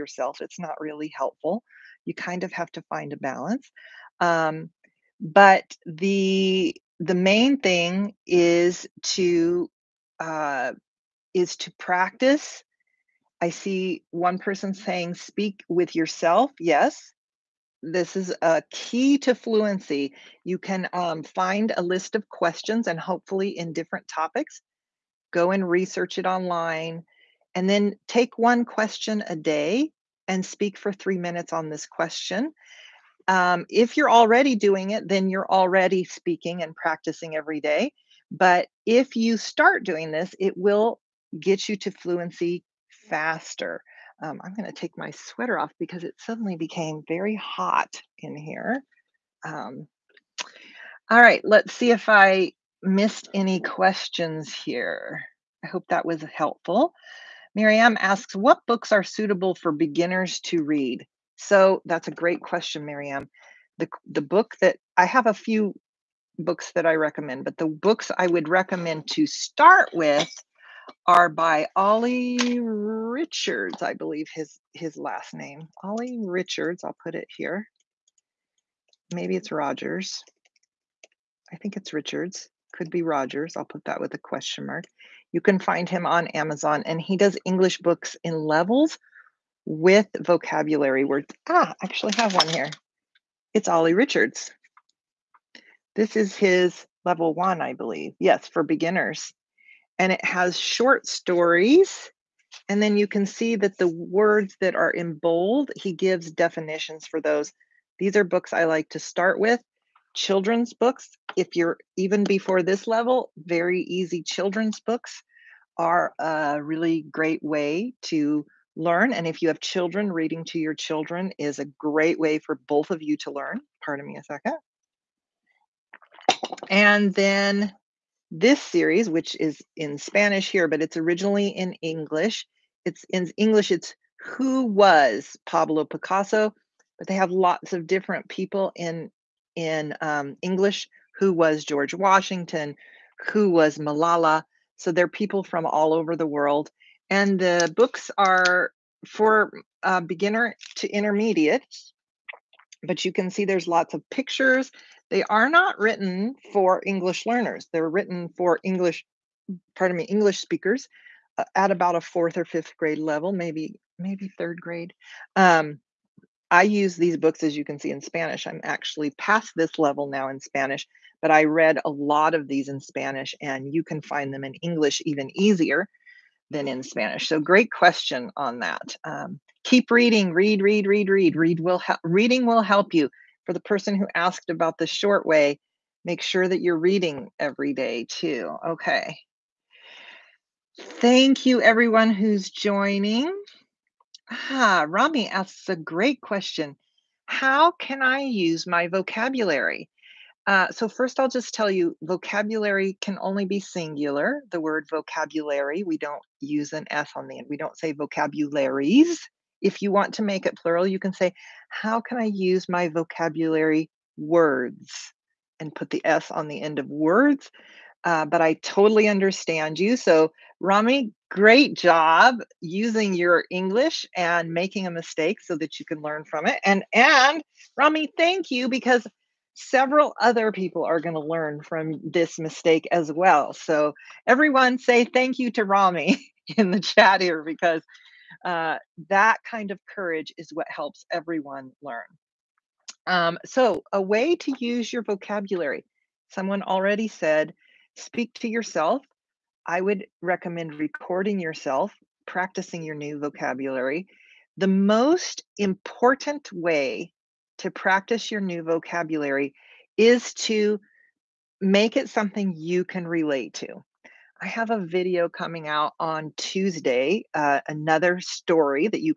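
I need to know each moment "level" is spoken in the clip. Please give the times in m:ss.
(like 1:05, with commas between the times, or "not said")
1:28, 1:37, 1:52, 2:42, 2:49.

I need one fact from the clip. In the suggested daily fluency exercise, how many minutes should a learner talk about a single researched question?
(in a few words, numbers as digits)
3.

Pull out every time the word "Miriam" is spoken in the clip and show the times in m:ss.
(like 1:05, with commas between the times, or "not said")
0:57, 1:02.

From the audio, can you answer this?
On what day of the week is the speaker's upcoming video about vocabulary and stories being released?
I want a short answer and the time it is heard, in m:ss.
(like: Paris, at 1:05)
Tuesday, at 4:26.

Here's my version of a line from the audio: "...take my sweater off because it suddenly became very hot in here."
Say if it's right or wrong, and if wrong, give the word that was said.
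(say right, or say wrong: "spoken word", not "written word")
right.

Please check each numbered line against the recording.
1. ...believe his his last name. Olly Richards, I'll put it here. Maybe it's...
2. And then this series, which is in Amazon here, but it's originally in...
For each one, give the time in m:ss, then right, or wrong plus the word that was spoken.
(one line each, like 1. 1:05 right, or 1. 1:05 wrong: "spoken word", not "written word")
1. 1:13 right
2. 2:06 wrong: "Spanish", not "Amazon".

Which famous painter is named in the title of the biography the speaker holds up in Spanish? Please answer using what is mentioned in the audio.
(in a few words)
Pablo Picasso.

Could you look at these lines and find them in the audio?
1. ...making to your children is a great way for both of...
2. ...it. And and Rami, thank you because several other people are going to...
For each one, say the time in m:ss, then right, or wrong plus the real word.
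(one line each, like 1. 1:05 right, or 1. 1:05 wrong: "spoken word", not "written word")
1. 2:00 wrong: "reading", not "making"
2. 3:46 right.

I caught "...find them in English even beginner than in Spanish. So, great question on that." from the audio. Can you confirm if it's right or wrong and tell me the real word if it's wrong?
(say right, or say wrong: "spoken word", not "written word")
wrong: "easier", not "beginner".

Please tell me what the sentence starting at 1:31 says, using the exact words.
Ah, I actually have one here.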